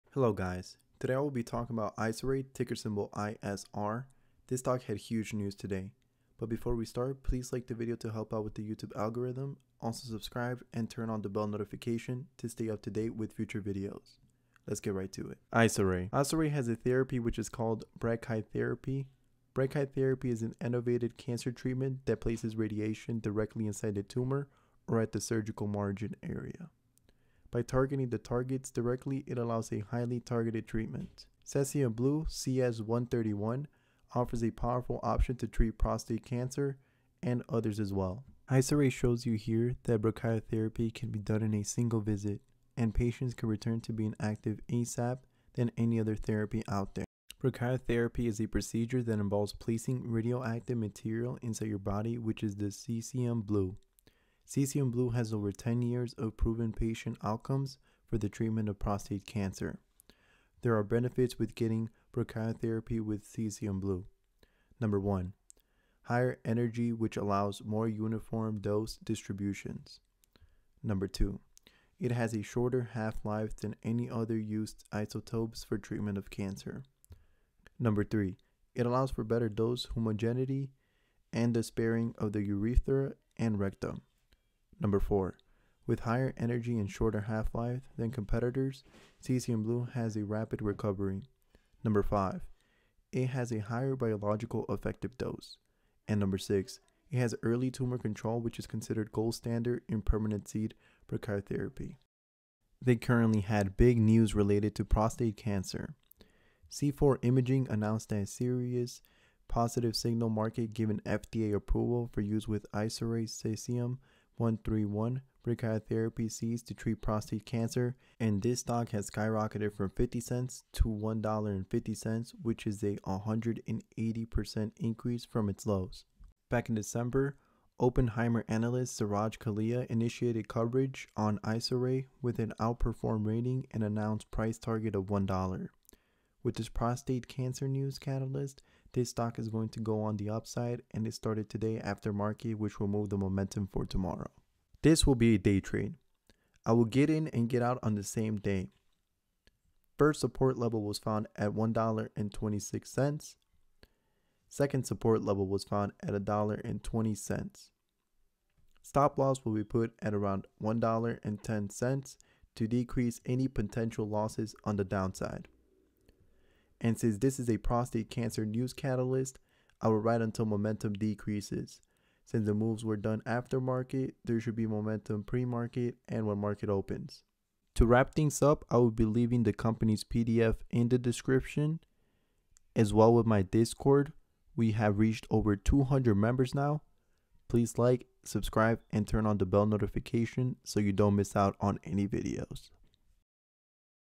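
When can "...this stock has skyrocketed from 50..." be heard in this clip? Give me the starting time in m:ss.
1:58.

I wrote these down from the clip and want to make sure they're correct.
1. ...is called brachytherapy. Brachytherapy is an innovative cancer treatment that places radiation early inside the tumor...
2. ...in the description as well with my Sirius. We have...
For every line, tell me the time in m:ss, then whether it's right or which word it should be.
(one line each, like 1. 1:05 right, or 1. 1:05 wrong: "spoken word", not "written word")
1. 0:17 wrong: "directly", not "early"
2. 3:00 wrong: "Discord", not "Sirius".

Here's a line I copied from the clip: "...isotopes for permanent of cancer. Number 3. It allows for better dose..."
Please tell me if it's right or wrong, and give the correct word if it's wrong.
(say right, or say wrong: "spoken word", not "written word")
wrong: "treatment", not "permanent".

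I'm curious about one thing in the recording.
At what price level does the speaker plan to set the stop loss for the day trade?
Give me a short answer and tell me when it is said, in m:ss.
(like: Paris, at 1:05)
$1.10, at 2:40.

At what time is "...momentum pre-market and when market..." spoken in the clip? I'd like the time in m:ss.
2:54.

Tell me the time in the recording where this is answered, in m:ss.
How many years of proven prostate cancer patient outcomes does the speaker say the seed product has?
0:55.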